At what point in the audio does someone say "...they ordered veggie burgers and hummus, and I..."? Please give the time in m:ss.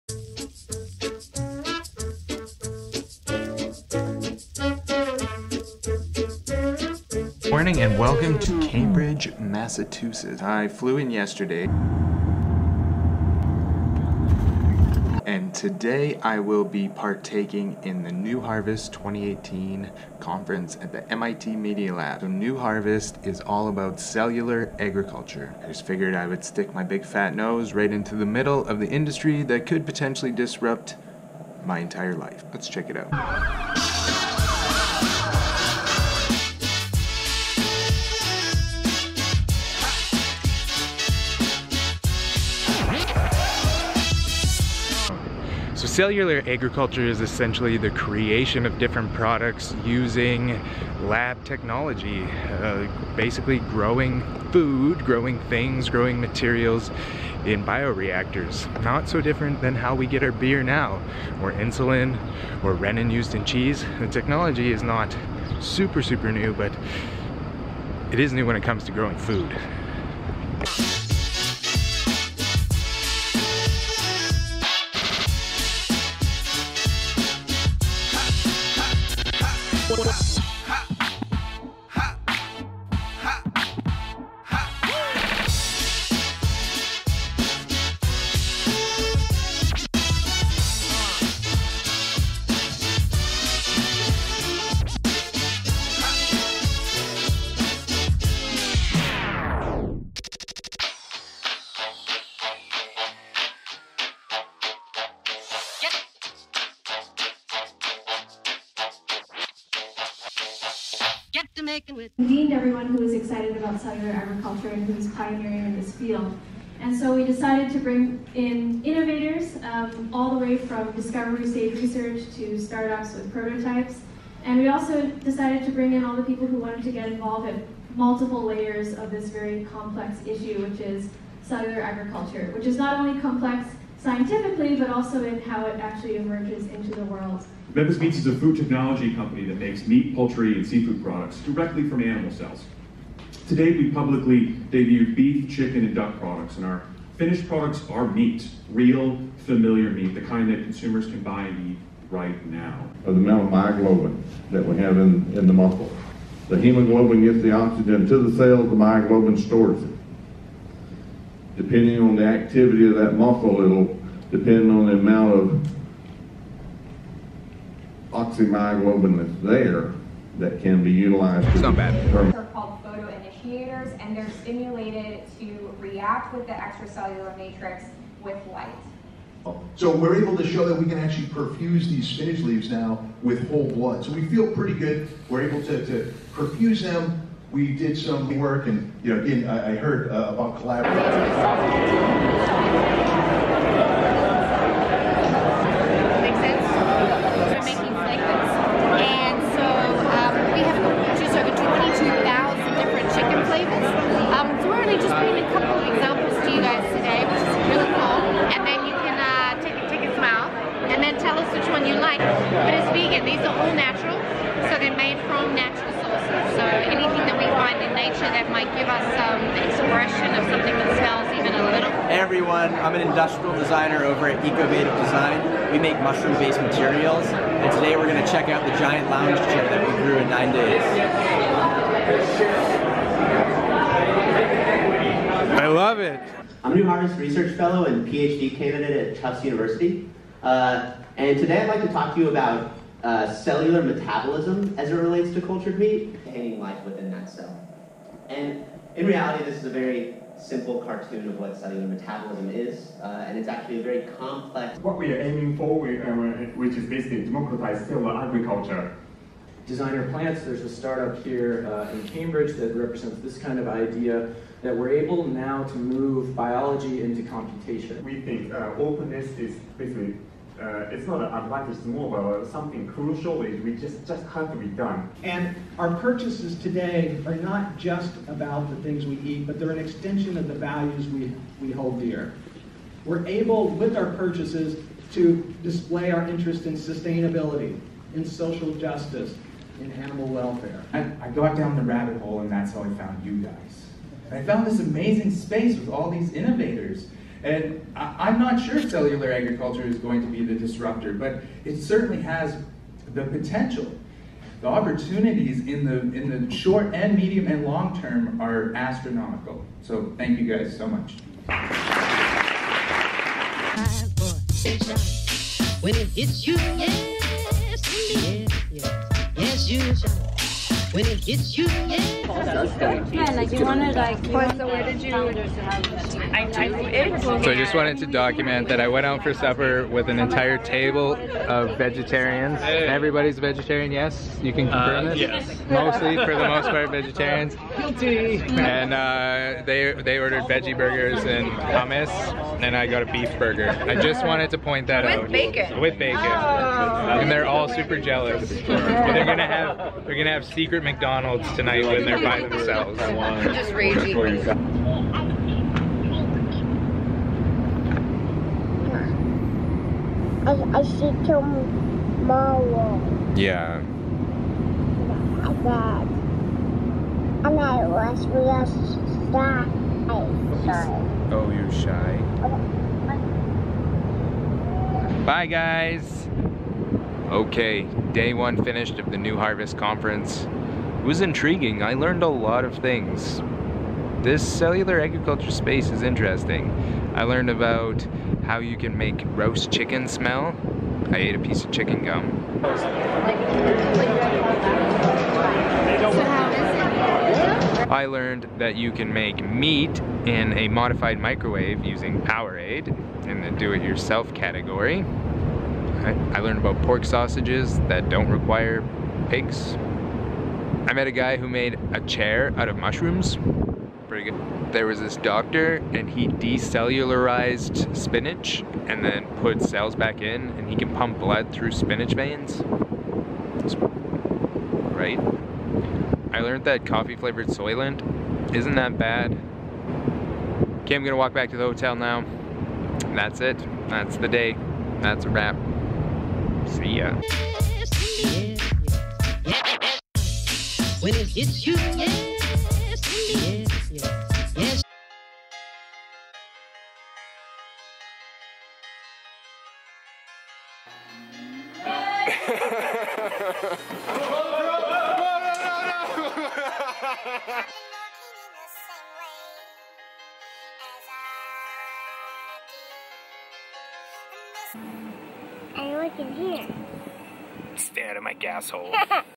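5:39.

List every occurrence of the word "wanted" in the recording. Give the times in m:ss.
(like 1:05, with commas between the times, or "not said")
2:06, 5:27, 5:44.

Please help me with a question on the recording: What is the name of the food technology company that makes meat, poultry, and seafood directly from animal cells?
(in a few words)
Memphis Meats.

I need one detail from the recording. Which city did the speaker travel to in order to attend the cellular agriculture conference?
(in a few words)
Cambridge, Massachusetts.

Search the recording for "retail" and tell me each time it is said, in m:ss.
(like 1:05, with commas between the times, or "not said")
not said.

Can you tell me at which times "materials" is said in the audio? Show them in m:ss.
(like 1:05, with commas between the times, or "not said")
0:56, 3:46.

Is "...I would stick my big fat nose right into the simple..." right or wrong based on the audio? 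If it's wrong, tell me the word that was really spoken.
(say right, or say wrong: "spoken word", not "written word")
wrong: "middle", not "simple".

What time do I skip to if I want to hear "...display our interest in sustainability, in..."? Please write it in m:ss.
4:45.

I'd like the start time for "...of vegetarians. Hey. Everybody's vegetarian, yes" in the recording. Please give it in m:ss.
5:31.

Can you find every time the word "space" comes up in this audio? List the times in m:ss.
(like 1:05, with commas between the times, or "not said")
4:55, 6:25.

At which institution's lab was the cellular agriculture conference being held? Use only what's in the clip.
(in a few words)
MIT Media Lab.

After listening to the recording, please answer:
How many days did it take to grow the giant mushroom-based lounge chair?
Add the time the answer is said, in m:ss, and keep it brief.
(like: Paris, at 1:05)
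9, at 3:50.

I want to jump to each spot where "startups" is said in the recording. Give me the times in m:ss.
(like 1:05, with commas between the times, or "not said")
2:02, 4:20.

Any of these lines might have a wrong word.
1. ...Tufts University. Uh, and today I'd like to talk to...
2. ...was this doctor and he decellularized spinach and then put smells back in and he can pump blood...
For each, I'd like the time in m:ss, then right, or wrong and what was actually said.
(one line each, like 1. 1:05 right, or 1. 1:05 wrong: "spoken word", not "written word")
1. 3:59 right
2. 6:54 wrong: "cells", not "smells".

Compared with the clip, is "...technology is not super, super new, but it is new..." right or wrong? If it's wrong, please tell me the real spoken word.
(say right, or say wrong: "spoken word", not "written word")
right.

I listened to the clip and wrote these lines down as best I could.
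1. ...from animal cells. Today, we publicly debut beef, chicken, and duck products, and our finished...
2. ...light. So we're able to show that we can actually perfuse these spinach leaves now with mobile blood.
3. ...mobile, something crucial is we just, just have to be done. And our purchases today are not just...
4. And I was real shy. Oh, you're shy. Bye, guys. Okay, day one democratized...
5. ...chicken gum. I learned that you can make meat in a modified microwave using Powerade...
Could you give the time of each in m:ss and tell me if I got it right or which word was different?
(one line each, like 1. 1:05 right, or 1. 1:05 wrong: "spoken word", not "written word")
1. 2:21 right
2. 2:58 wrong: "whole", not "mobile"
3. 4:31 right
4. 6:07 wrong: "finished", not "democratized"
5. 6:31 right.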